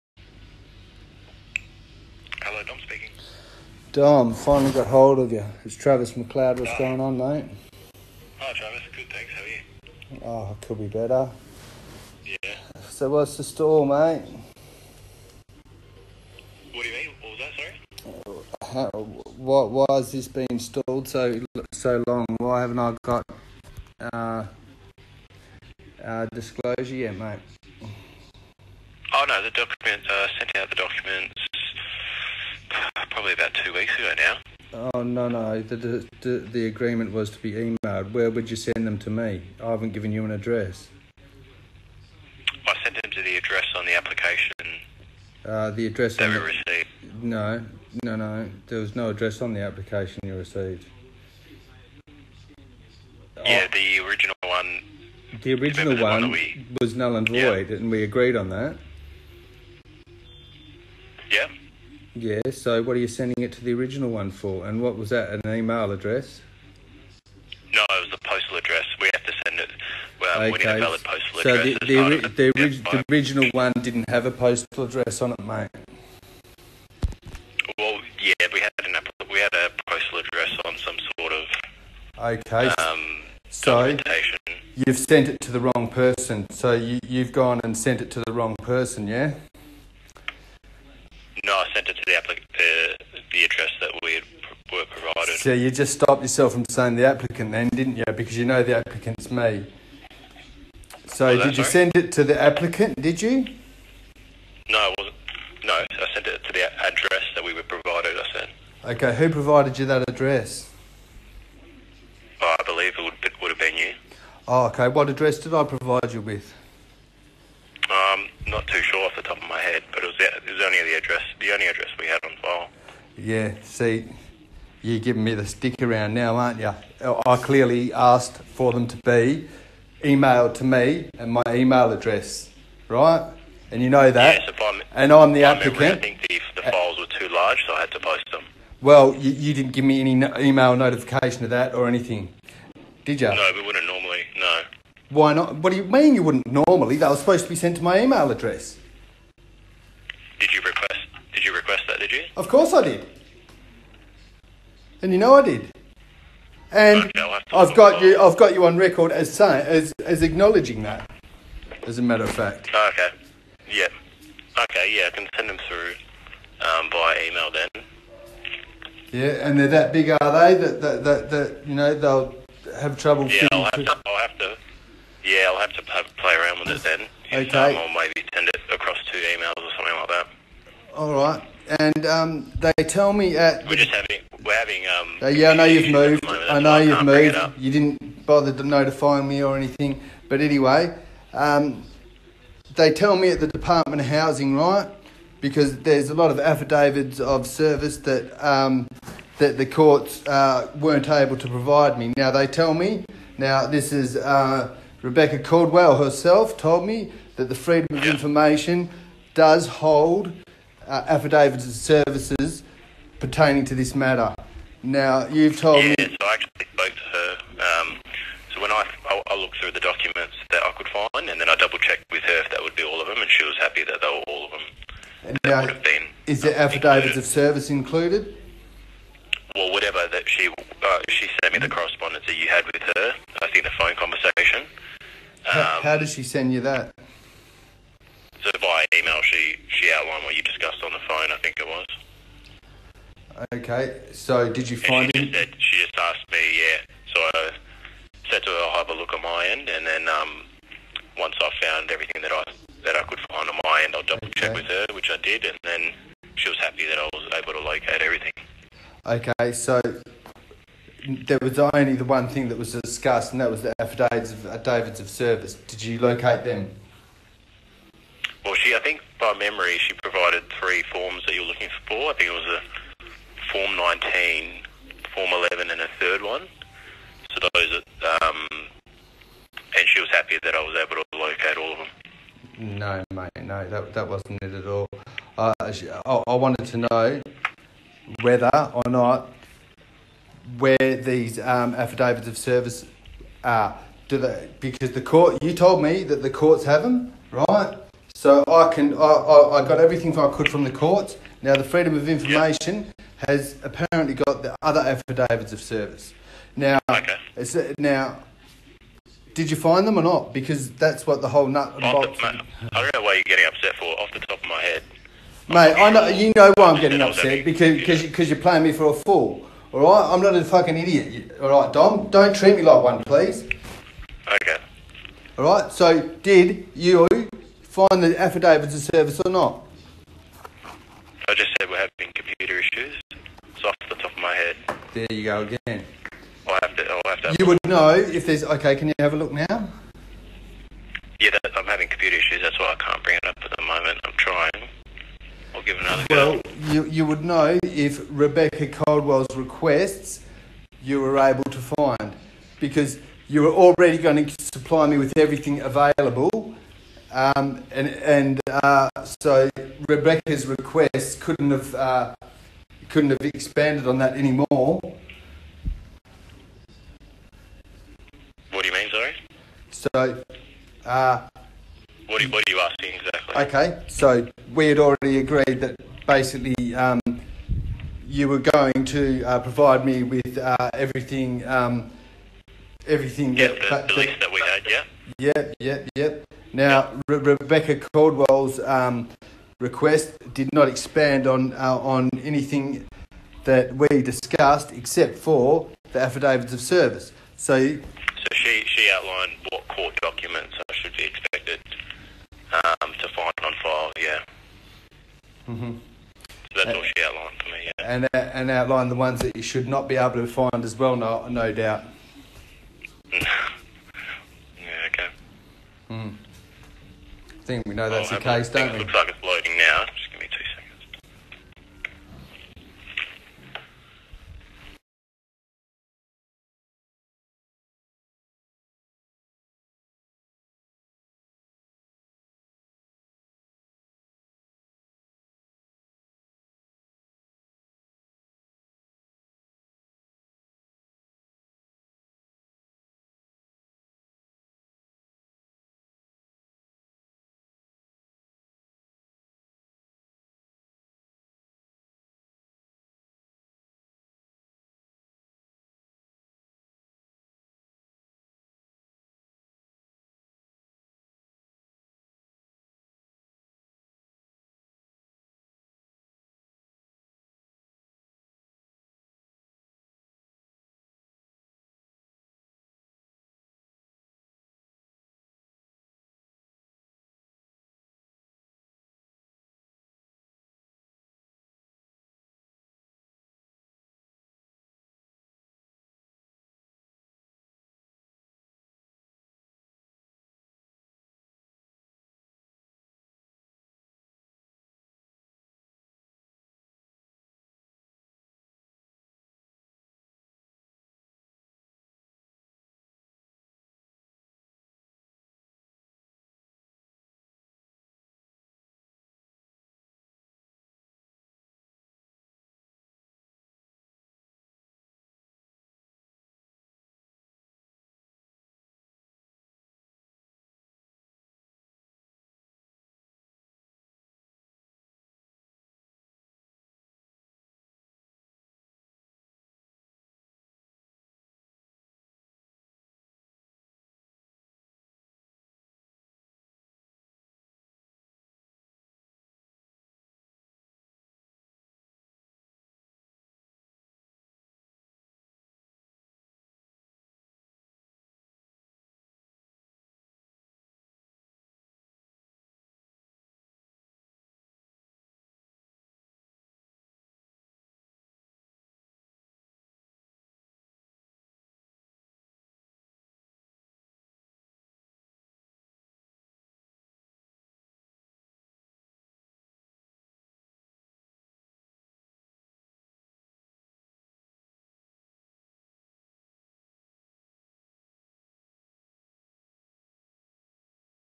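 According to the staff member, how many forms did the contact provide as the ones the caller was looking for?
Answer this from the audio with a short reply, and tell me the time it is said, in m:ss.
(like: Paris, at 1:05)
3, at 4:30.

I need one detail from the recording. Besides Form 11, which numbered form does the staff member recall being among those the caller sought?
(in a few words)
Form 19.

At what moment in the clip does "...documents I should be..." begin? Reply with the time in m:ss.
6:40.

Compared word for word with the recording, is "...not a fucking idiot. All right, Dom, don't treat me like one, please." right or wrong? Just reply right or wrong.
right.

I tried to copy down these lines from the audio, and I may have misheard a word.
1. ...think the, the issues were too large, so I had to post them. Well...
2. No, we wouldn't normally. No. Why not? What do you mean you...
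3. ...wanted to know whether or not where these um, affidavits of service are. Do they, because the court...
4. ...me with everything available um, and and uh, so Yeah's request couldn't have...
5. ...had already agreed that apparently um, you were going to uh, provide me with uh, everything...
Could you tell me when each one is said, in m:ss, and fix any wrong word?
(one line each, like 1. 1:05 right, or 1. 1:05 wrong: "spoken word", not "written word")
1. 2:16 wrong: "files", not "issues"
2. 2:23 right
3. 4:46 right
4. 5:54 wrong: "Rebecca", not "Yeah"
5. 6:14 wrong: "basically", not "apparently".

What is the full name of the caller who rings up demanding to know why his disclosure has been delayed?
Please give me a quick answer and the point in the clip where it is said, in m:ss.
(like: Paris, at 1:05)
Travis McLeod, at 0:05.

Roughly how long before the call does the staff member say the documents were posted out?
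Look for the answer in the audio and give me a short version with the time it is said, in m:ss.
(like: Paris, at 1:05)
about two weeks ago, at 0:33.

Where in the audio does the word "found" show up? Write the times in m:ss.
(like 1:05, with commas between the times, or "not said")
4:11.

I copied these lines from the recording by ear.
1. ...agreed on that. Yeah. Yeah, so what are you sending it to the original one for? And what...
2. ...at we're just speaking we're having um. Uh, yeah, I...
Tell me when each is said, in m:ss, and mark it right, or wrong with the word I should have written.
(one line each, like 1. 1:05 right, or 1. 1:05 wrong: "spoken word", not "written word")
1. 0:58 right
2. 3:03 wrong: "having", not "speaking".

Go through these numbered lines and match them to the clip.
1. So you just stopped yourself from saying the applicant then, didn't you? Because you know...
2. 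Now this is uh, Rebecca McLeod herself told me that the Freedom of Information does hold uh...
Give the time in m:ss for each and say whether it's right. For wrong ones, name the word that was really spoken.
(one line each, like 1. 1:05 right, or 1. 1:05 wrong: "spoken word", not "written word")
1. 1:35 right
2. 3:23 wrong: "Caldwell", not "McLeod".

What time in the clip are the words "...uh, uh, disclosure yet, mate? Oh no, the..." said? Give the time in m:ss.
0:24.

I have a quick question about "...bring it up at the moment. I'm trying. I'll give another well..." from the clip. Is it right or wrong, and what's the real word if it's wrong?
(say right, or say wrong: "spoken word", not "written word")
right.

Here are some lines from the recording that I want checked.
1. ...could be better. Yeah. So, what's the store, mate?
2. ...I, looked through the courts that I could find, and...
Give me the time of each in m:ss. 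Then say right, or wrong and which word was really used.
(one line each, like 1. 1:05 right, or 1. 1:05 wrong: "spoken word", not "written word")
1. 0:10 right
2. 3:39 wrong: "documents", not "courts".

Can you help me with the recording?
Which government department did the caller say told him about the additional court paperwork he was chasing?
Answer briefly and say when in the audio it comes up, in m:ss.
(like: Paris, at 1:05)
Department of Housing, at 3:13.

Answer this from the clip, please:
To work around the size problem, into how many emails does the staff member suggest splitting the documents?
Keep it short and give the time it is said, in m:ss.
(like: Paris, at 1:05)
2, at 2:59.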